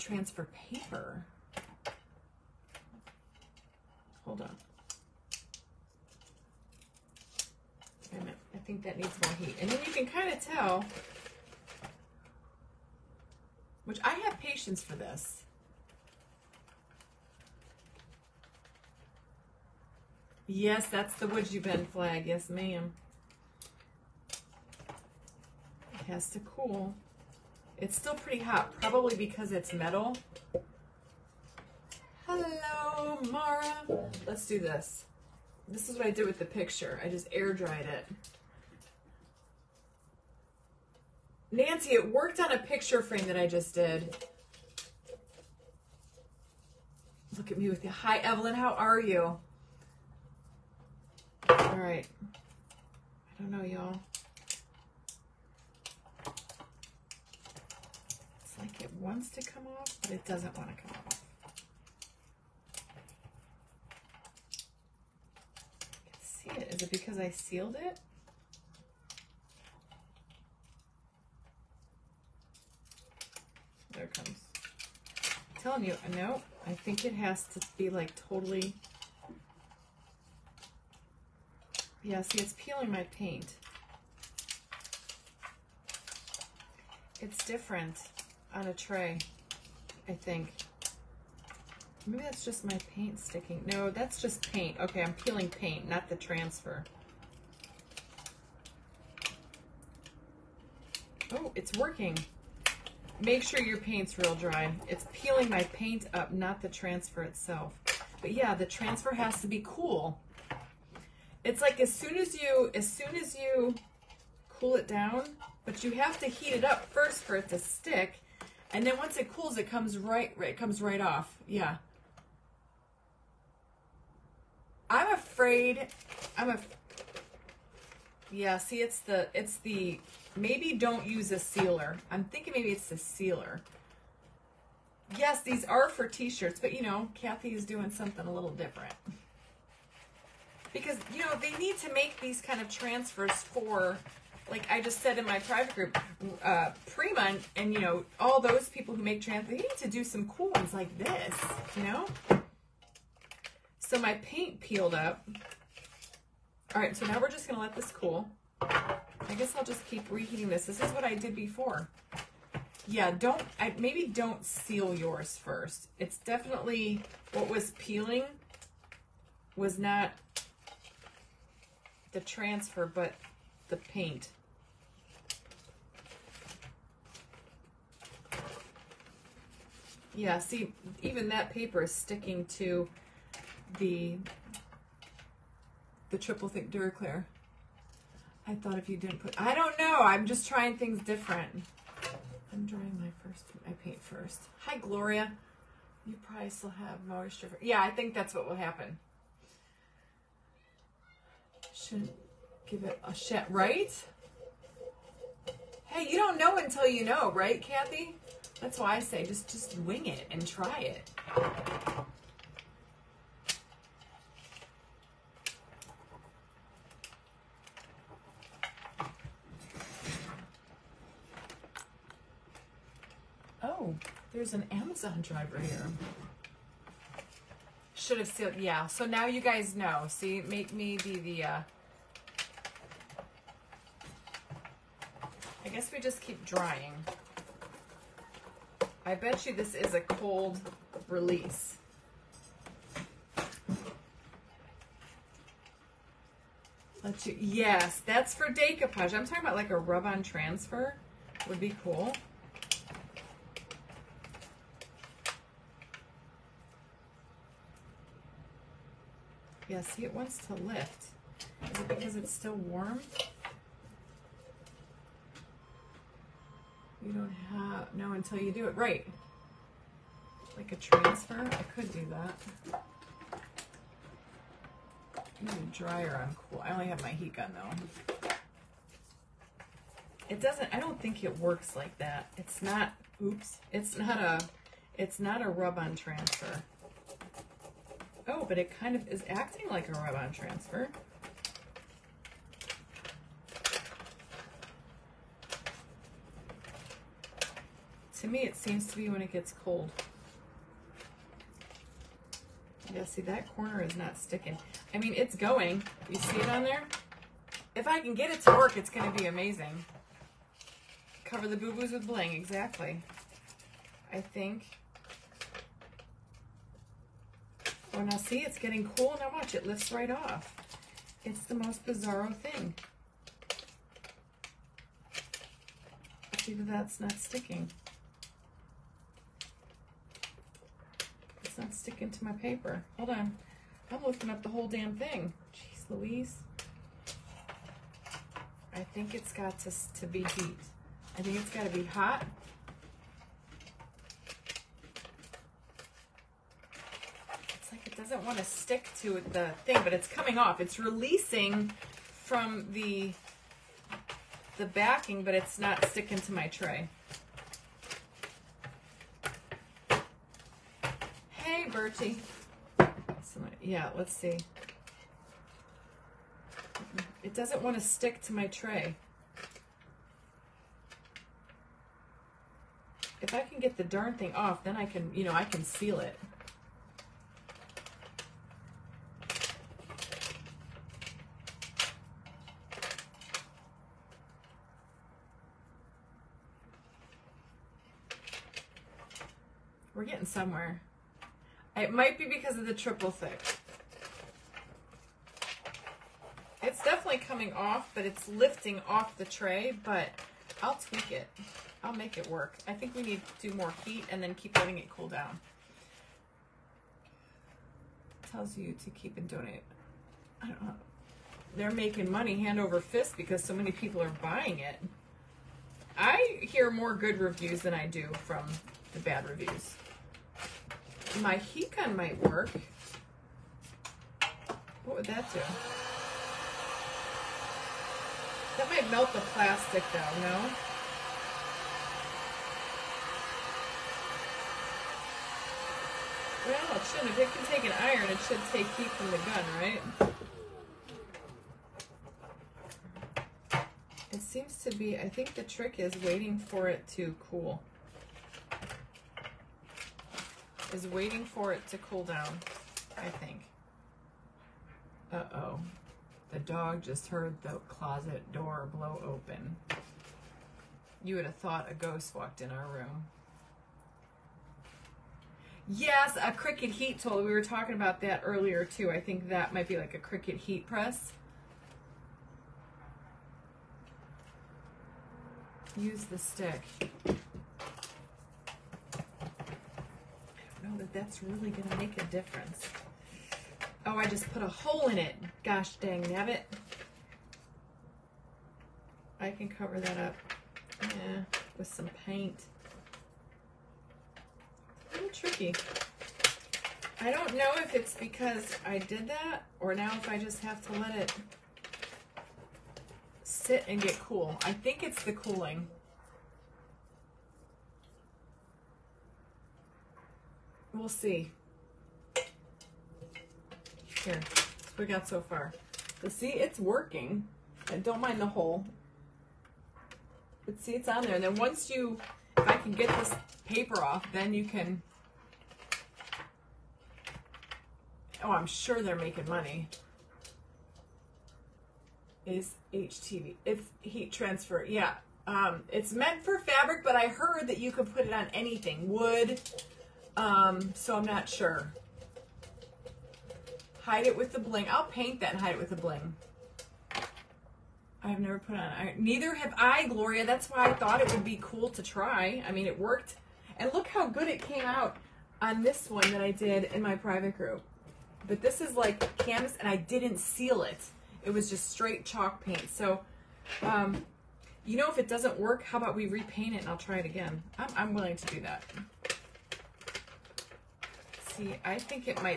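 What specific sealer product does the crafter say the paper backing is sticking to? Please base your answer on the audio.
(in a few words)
triple thick Duraclear.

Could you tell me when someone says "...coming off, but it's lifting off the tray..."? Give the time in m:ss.
6:37.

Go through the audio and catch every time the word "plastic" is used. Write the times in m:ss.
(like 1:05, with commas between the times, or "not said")
7:09.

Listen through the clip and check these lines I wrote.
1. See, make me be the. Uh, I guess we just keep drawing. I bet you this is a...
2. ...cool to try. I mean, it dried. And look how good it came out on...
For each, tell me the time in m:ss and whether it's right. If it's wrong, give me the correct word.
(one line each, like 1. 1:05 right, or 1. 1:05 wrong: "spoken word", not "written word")
1. 3:50 wrong: "drying", not "drawing"
2. 9:11 wrong: "worked", not "dried".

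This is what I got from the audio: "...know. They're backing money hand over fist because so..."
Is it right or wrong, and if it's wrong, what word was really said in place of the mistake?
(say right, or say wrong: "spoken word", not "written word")
wrong: "making", not "backing".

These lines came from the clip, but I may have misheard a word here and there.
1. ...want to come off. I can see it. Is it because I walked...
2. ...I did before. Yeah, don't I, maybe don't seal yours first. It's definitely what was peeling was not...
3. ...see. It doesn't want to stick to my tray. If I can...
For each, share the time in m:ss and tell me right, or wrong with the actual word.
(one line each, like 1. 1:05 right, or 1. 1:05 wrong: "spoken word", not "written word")
1. 1:00 wrong: "sealed", not "walked"
2. 2:41 right
3. 6:04 right.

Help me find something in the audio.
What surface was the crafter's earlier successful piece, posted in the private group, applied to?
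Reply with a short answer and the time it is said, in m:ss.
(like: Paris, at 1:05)
canvas, at 9:19.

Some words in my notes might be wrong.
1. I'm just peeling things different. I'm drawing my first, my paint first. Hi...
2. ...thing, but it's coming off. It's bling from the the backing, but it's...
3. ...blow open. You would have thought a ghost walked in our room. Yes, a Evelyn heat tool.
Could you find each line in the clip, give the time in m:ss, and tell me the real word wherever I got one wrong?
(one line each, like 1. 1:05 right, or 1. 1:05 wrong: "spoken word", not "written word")
1. 3:09 wrong: "trying", not "peeling"
2. 5:49 wrong: "releasing", not "bling"
3. 7:38 wrong: "Cricut", not "Evelyn".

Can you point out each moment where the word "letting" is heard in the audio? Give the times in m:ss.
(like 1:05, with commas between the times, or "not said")
6:44.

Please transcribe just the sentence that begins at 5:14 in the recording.
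I think And now see, it's getting cool.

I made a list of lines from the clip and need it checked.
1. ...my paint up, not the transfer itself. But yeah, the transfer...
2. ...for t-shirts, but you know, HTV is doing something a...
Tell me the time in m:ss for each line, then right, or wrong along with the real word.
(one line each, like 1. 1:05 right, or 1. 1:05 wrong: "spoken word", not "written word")
1. 1:45 right
2. 2:15 wrong: "Kathy", not "HTV".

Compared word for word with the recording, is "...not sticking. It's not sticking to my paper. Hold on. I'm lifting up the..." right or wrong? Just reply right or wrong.
right.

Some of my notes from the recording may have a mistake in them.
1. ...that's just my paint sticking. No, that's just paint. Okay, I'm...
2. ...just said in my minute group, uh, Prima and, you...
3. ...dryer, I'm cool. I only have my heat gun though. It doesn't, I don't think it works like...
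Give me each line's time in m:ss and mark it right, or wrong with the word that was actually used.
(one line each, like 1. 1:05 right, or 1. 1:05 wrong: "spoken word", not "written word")
1. 1:32 right
2. 2:24 wrong: "private", not "minute"
3. 4:35 right.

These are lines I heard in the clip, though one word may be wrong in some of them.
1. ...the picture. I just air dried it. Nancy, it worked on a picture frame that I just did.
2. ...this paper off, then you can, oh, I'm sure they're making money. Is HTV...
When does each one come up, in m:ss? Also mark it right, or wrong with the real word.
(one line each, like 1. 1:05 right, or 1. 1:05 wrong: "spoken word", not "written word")
1. 0:36 right
2. 8:42 right.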